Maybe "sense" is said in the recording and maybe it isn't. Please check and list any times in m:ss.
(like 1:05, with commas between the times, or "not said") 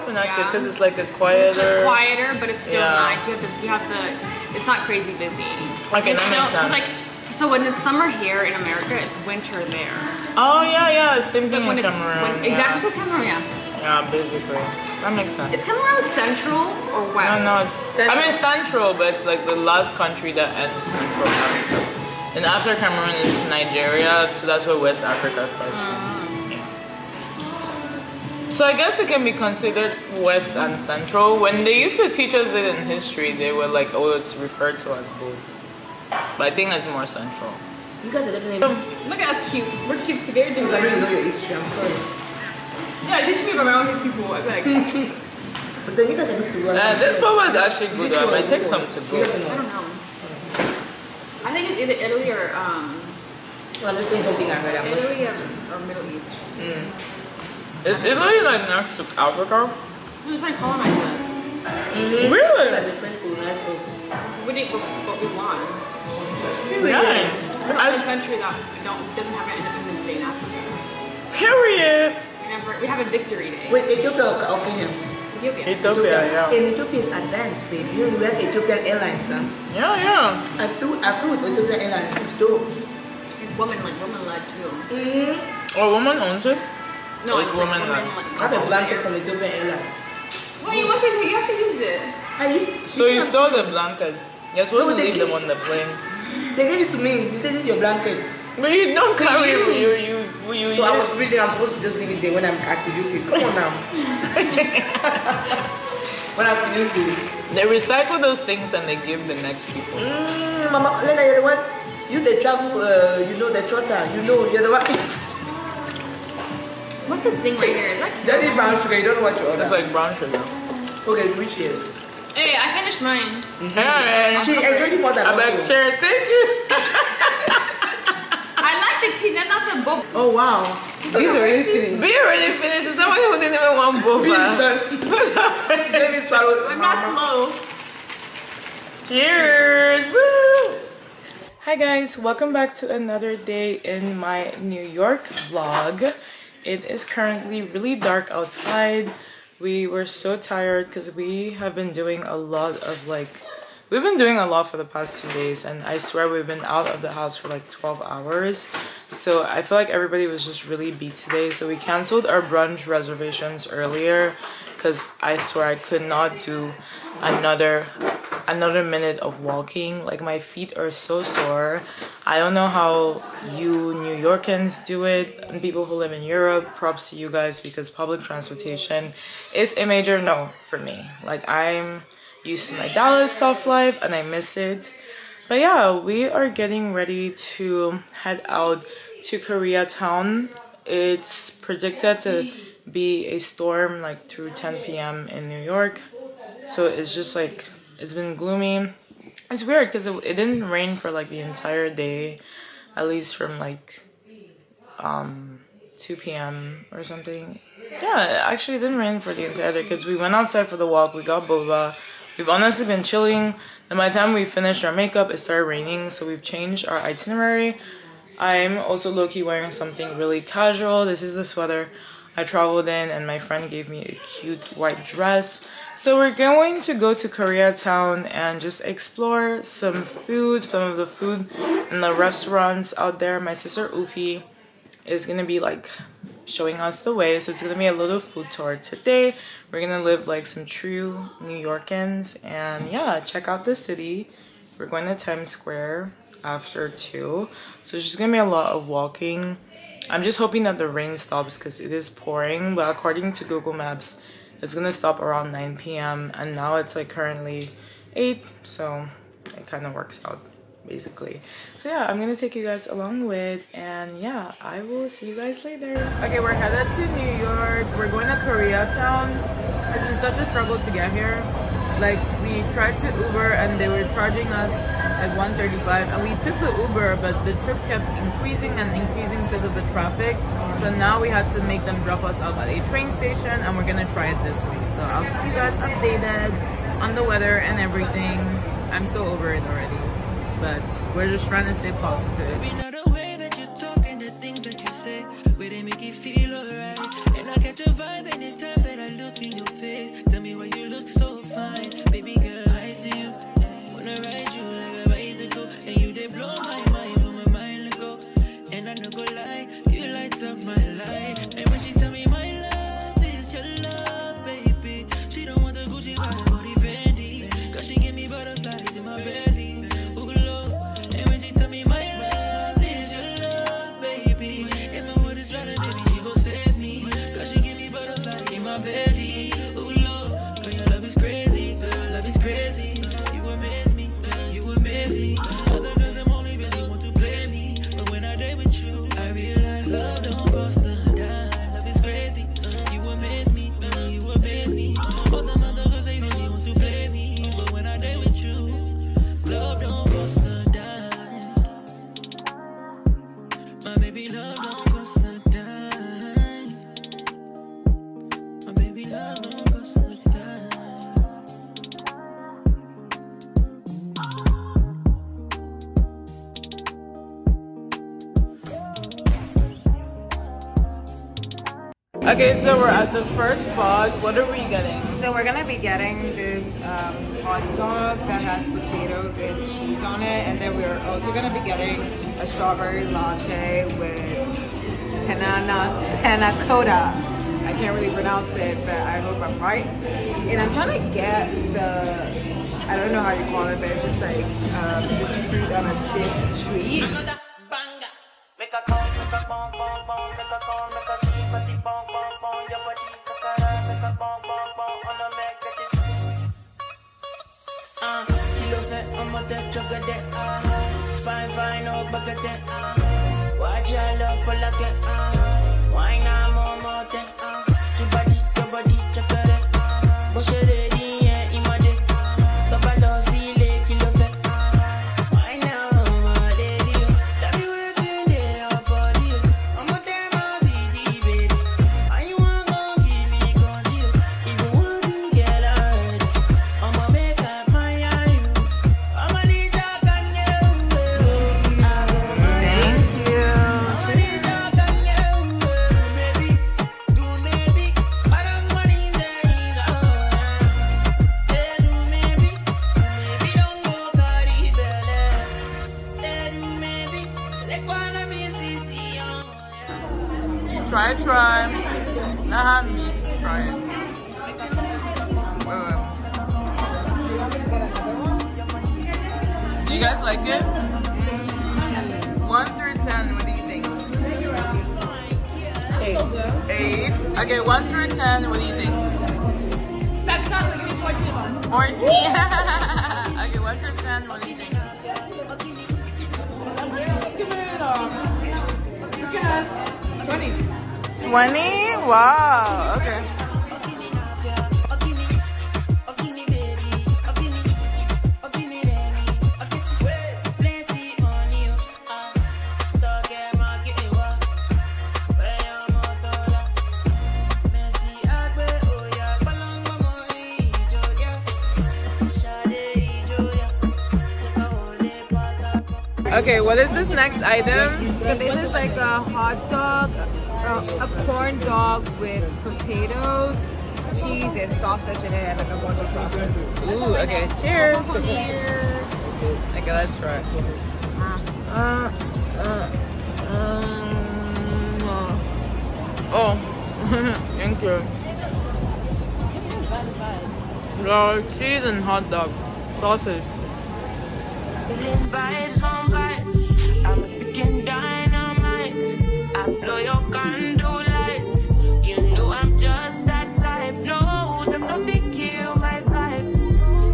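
0:06, 0:15.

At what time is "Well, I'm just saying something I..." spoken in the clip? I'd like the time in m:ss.
0:53.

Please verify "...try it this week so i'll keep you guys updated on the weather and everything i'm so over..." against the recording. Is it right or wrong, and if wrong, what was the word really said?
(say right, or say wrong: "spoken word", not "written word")
right.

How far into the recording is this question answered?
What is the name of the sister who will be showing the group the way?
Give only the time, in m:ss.
3:53.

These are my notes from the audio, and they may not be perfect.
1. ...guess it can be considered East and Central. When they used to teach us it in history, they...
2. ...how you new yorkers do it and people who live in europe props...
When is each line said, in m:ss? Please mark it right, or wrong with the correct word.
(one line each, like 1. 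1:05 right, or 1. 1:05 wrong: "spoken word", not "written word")
1. 0:28 wrong: "West", not "East"
2. 2:52 right.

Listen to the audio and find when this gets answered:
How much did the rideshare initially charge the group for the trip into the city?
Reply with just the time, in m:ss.
4:35.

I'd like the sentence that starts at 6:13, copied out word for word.
first box, what are we getting?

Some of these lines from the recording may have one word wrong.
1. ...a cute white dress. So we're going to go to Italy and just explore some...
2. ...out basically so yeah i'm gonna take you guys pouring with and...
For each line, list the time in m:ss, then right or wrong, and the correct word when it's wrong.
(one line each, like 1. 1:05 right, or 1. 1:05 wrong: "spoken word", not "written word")
1. 3:44 wrong: "Koreatown", not "Italy"
2. 4:20 wrong: "along", not "pouring".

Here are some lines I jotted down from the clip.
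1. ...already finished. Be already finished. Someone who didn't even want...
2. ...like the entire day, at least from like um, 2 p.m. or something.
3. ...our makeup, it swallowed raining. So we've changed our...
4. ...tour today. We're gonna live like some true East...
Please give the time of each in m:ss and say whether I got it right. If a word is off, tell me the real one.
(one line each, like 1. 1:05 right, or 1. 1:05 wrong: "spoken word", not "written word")
1. 2:11 right
2. 3:21 right
3. 3:34 wrong: "started", not "swallowed"
4. 3:58 wrong: "New", not "East".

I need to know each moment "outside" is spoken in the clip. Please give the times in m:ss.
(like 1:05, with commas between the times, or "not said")
2:28, 3:30.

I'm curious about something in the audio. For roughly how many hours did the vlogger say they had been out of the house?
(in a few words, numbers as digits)
12 hours.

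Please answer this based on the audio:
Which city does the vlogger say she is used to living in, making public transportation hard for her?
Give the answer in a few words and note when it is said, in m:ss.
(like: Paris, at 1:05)
Dallas, at 3:02.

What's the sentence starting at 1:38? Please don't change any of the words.
No, you don't to carry you.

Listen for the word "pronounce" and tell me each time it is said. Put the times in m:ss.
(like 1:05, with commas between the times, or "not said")
6:28.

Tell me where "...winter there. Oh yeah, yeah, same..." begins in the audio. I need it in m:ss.
0:09.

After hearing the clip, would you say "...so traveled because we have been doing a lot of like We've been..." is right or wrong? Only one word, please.
wrong.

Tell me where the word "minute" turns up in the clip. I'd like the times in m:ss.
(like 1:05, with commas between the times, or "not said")
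2:48.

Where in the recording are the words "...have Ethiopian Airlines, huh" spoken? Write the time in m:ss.
1:18.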